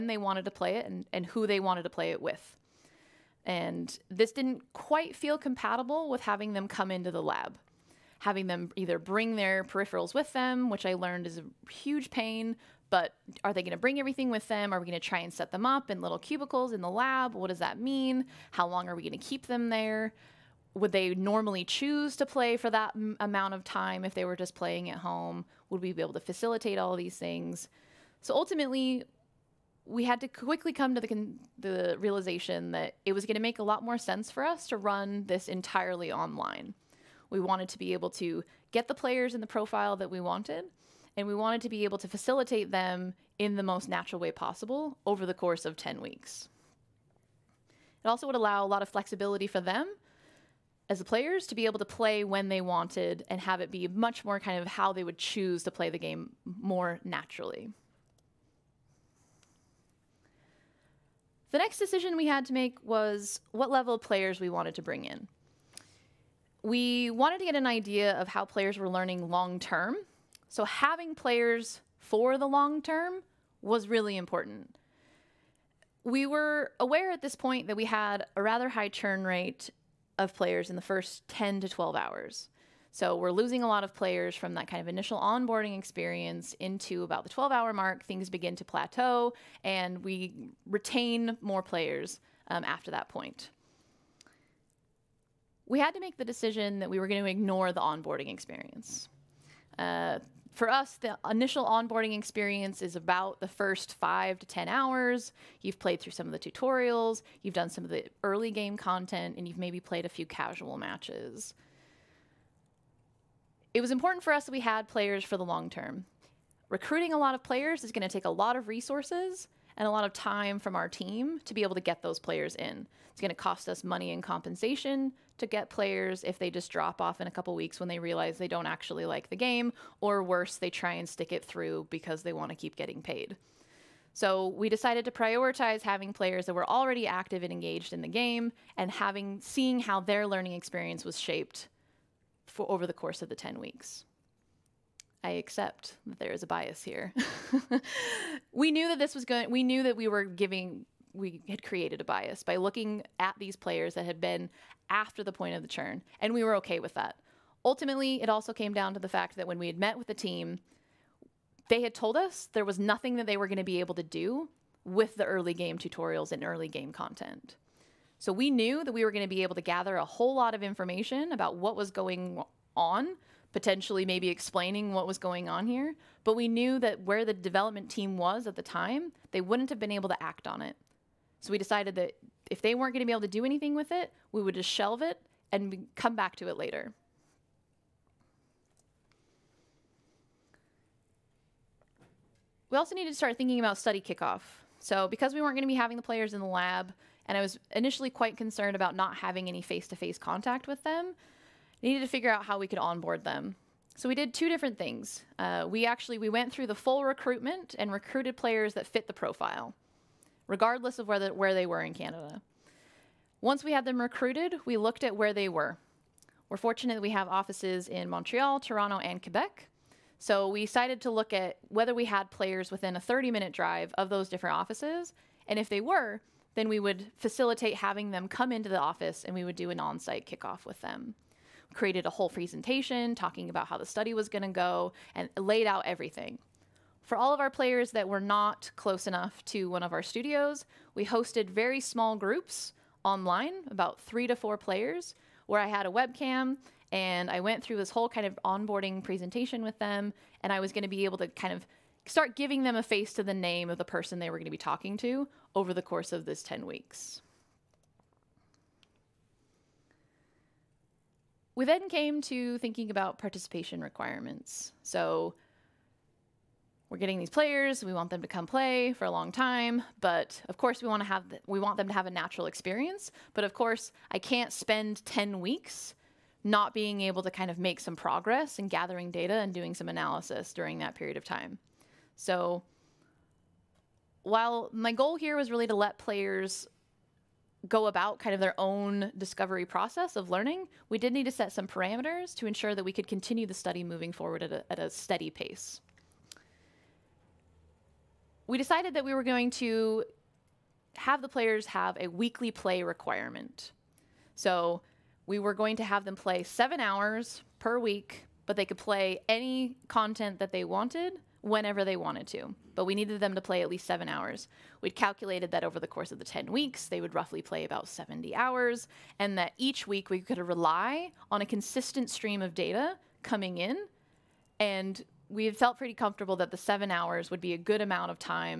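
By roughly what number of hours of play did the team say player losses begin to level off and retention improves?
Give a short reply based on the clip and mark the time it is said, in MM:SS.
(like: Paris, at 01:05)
12, at 01:27.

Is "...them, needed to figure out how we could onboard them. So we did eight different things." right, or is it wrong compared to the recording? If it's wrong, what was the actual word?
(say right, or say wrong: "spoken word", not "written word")
wrong: "two", not "eight".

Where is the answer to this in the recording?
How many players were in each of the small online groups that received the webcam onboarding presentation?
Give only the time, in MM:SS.
04:04.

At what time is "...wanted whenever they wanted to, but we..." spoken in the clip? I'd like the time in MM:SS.
05:10.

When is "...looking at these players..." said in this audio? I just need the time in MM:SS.
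02:32.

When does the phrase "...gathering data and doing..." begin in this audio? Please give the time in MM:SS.
04:38.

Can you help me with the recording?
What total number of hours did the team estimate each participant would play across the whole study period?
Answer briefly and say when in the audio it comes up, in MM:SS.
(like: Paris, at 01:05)
70, at 05:17.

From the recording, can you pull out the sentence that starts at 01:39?
Uh, for us, the initial onboarding experience is about the first five to 10 hours.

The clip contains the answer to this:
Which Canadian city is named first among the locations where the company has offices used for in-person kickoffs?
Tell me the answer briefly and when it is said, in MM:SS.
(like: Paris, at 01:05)
Montreal, at 03:38.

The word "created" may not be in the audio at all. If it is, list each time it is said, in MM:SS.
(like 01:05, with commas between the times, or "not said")
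02:31, 03:51.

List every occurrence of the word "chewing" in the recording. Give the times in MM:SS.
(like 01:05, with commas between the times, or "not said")
not said.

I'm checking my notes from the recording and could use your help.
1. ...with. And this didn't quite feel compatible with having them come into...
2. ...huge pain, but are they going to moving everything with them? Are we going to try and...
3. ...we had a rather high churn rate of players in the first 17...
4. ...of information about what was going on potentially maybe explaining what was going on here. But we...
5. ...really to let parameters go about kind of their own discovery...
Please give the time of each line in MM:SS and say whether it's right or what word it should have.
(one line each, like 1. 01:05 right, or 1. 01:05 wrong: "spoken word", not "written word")
1. 00:02 right
2. 00:11 wrong: "bring", not "moving"
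3. 01:17 wrong: "10", not "17"
4. 02:50 right
5. 04:45 wrong: "players", not "parameters".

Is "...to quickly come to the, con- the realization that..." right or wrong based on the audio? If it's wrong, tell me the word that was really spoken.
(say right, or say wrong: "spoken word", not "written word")
right.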